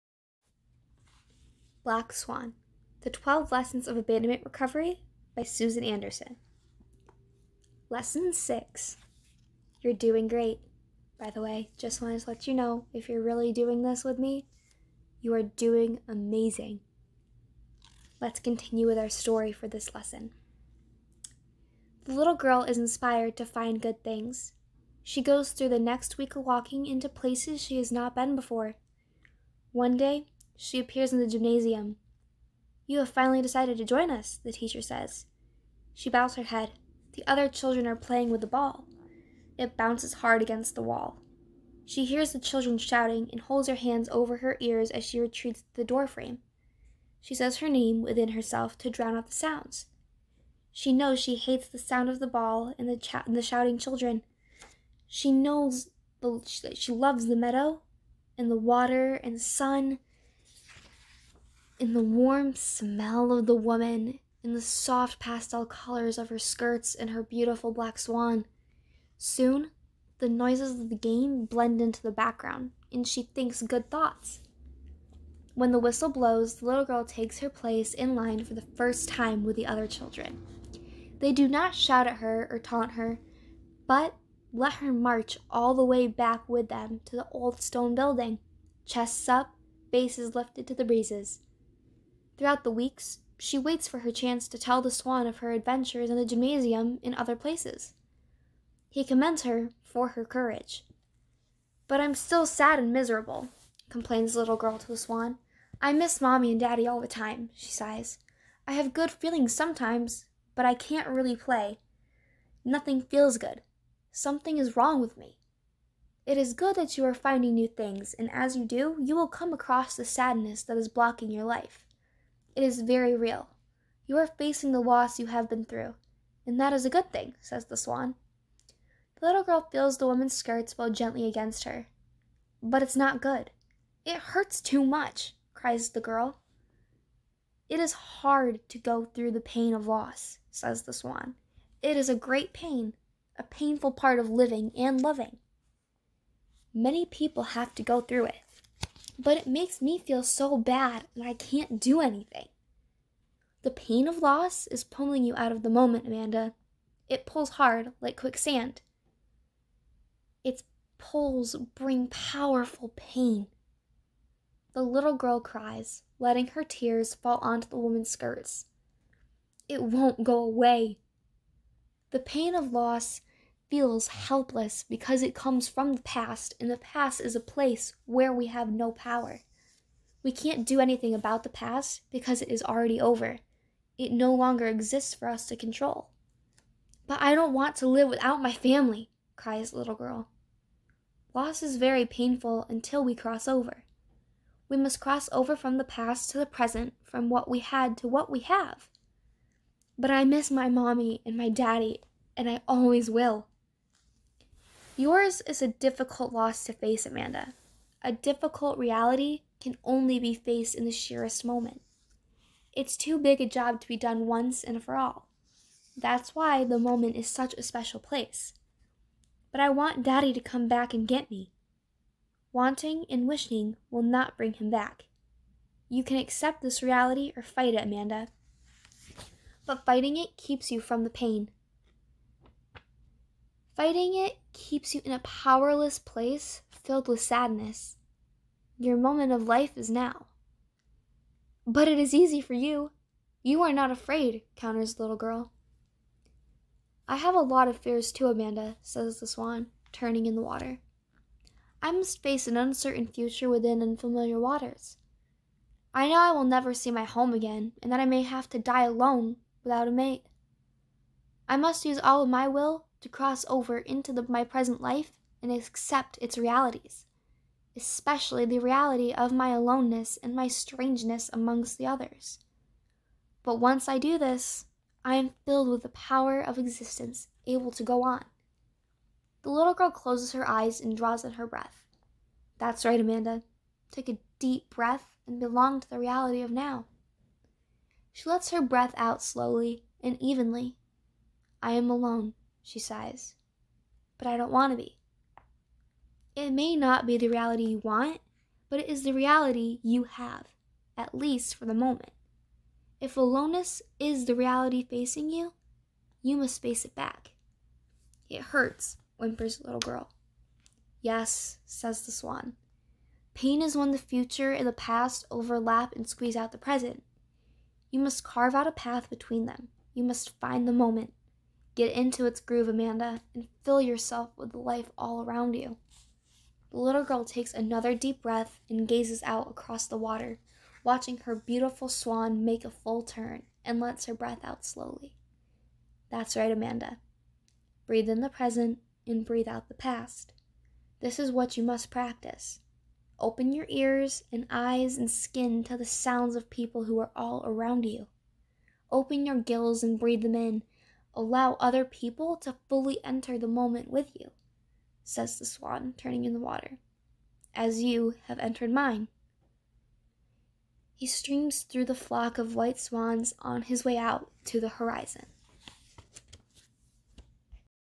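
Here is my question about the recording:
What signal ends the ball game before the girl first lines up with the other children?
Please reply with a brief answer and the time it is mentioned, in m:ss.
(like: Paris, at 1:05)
the whistle, at 1:15.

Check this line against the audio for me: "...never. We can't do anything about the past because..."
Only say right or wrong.
wrong.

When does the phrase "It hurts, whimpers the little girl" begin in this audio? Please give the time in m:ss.
5:08.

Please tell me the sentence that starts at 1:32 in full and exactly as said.
Throughout the weeks, she waits for her chance to tell the swan of her adventures in the gymnasium and other places.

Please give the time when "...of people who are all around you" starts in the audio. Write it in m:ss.
5:46.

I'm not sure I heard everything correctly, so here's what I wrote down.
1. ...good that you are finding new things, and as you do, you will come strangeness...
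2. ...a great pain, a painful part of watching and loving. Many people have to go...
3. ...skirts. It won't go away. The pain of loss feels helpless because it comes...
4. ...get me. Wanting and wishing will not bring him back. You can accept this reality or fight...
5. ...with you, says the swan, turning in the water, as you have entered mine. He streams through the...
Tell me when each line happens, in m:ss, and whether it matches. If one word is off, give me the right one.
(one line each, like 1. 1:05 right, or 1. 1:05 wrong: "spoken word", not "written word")
1. 1:56 wrong: "across", not "strangeness"
2. 2:22 wrong: "living", not "watching"
3. 2:48 right
4. 3:41 right
5. 5:53 right.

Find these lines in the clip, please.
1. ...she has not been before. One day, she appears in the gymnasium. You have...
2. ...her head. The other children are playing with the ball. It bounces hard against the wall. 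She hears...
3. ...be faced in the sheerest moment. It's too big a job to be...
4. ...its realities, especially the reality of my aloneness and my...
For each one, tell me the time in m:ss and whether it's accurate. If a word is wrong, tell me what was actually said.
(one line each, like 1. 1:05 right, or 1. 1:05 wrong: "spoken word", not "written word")
1. 0:27 right
2. 0:36 right
3. 3:30 right
4. 4:26 right.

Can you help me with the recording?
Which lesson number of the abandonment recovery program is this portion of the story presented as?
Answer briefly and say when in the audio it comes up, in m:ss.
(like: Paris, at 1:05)
Lesson 6, at 0:07.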